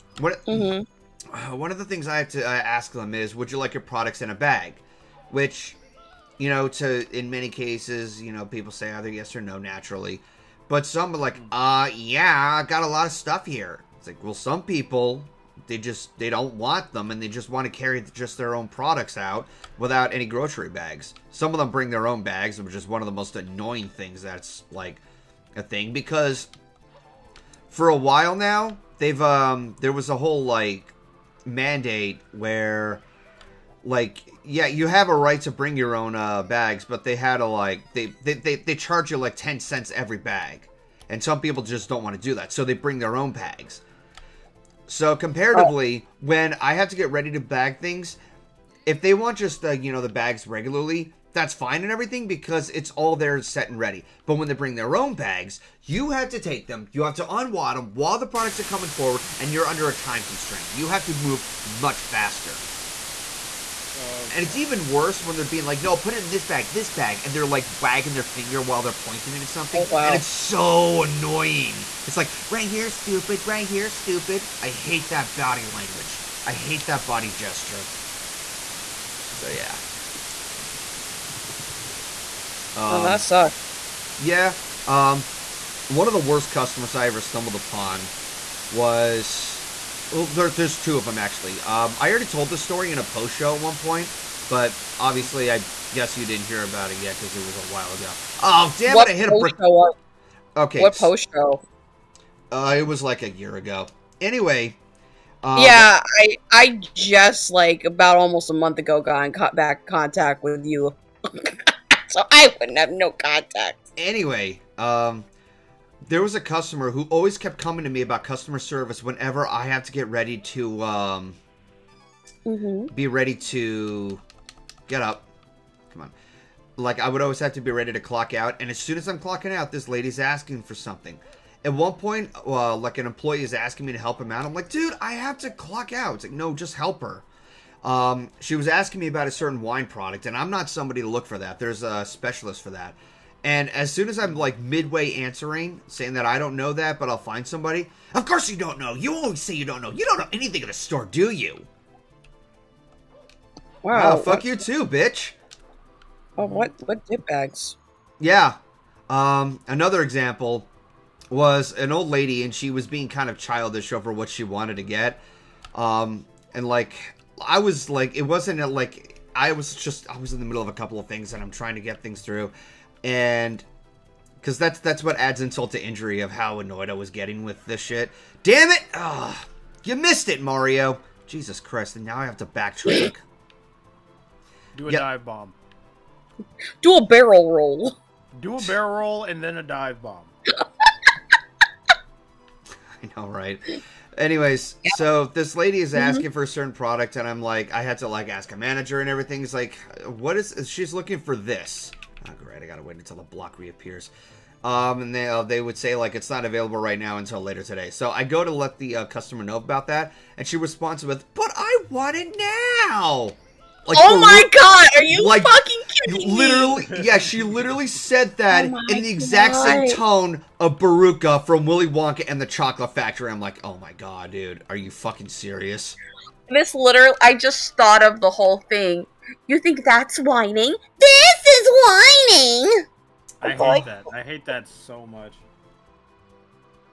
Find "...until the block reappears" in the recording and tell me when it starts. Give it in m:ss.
3:22.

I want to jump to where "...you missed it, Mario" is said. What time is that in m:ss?
2:59.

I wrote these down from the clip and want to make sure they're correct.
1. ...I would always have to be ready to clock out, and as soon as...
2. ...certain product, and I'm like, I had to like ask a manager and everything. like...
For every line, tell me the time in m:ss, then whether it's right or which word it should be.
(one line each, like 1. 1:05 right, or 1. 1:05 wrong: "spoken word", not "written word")
1. 2:06 right
2. 3:16 right.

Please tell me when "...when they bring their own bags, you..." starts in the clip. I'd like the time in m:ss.
0:54.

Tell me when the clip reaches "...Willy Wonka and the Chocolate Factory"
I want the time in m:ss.
3:41.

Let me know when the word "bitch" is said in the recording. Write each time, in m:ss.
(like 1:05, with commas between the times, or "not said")
2:34.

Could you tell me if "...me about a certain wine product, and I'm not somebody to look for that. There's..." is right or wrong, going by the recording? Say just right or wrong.
right.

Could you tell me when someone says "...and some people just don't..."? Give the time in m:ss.
0:41.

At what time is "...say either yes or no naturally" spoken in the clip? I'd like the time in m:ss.
0:08.